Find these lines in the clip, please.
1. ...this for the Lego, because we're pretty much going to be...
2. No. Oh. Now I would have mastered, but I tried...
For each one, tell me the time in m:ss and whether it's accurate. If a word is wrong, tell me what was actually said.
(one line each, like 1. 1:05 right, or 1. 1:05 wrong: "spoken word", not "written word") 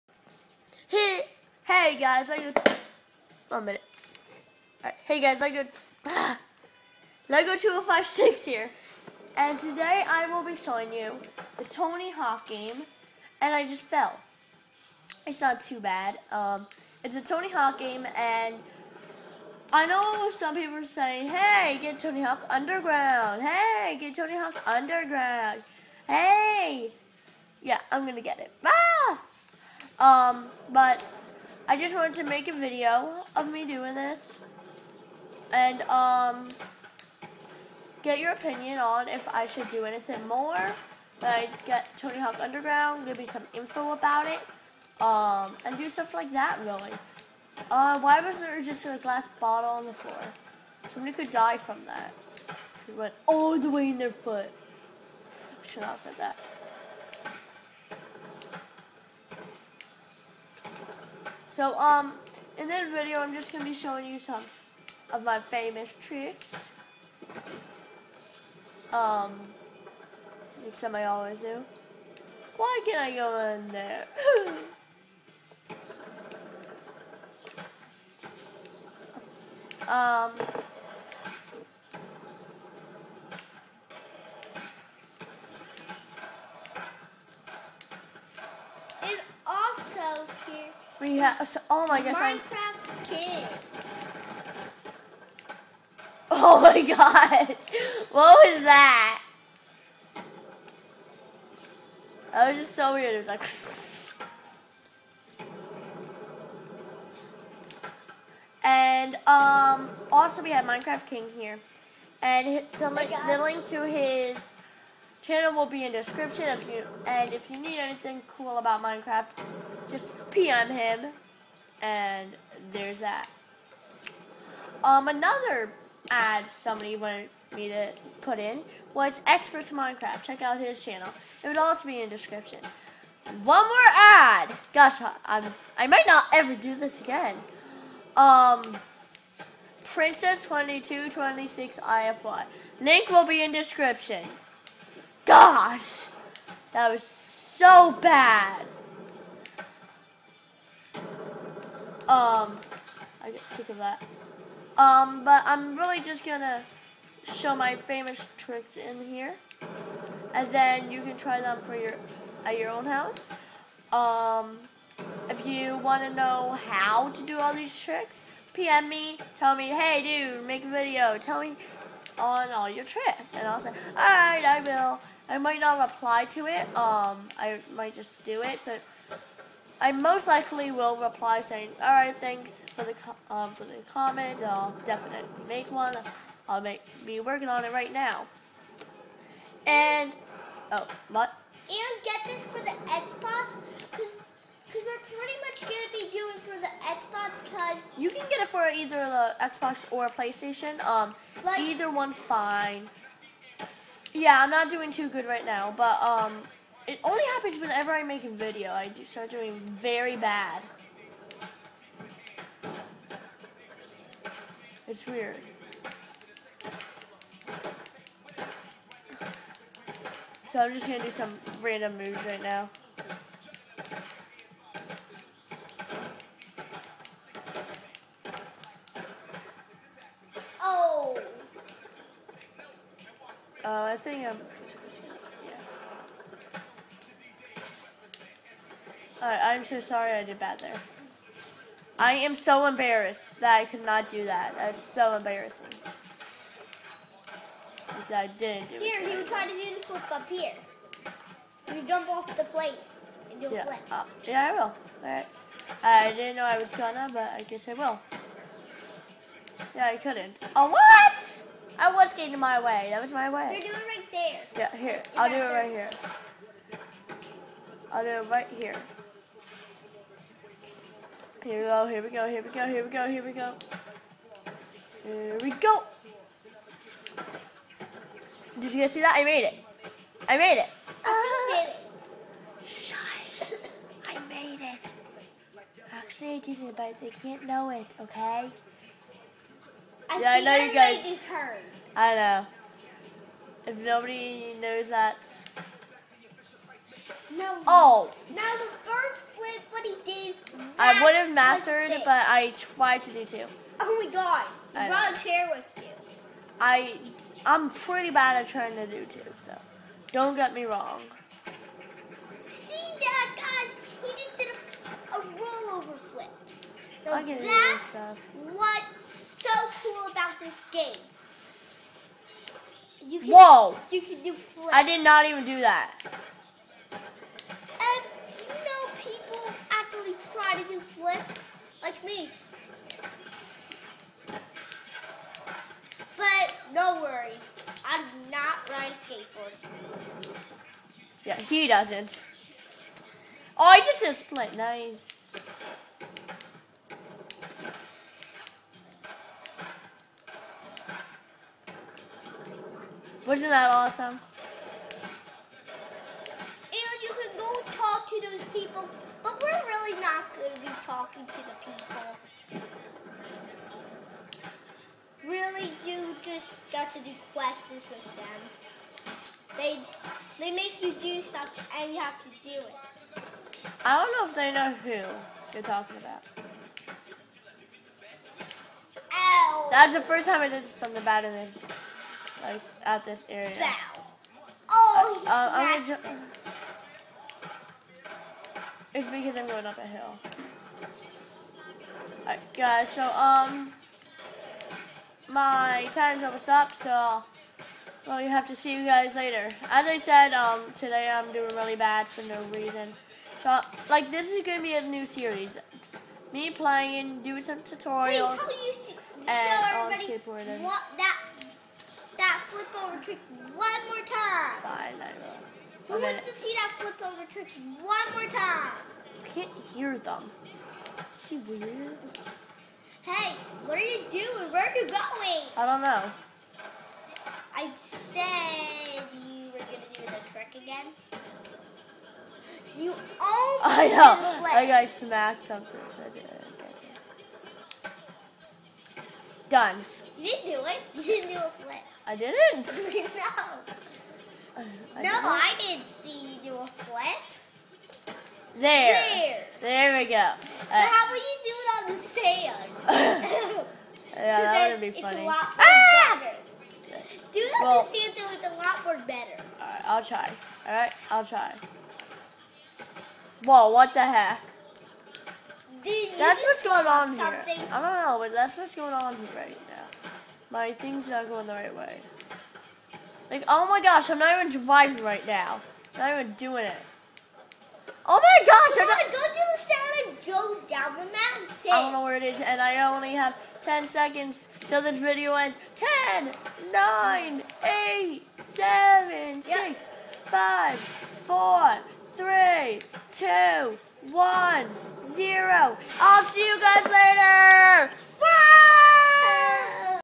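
1. 3:12 wrong: "Xbox", not "Lego"
2. 4:57 right.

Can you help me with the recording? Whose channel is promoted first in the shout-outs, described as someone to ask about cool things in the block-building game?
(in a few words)
Minecraft King.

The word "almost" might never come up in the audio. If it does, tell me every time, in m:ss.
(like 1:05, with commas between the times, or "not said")
6:36, 7:12.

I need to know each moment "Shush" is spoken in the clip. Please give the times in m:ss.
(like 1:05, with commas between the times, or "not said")
4:42.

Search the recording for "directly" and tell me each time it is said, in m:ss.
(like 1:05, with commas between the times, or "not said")
not said.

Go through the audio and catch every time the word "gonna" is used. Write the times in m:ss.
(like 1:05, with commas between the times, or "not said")
2:36, 3:40, 4:16, 6:56, 7:09.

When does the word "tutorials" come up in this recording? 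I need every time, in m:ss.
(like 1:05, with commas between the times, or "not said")
6:47.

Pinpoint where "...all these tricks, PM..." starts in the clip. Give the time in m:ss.
2:47.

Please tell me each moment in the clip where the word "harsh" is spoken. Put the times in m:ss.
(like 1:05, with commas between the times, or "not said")
not said.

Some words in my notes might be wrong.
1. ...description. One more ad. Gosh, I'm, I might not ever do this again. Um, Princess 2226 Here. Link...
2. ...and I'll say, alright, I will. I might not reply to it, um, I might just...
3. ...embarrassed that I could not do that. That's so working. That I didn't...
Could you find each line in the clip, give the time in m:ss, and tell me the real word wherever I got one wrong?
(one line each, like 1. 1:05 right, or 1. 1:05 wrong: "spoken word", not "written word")
1. 2:12 wrong: "IFY", not "Here"
2. 2:53 right
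3. 4:02 wrong: "embarrassing", not "working".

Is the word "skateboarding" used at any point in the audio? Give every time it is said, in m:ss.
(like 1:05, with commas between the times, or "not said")
6:50.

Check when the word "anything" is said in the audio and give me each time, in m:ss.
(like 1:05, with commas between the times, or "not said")
0:39, 1:57.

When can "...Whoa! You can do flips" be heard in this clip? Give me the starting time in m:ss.
5:23.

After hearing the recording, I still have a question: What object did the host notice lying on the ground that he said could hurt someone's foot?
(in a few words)
glass bottle.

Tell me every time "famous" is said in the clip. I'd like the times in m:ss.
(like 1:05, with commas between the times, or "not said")
1:05, 2:37.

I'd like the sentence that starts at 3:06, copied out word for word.
I'll make, be working on it right now.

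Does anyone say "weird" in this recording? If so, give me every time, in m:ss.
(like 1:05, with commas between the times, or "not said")
1:42, 3:35, 7:01.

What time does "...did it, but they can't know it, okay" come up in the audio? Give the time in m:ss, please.
4:46.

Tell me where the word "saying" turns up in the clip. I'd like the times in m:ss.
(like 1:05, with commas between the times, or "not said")
0:20, 3:01.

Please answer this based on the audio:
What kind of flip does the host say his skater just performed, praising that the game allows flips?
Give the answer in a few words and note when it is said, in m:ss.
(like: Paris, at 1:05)
rollover flip, at 5:15.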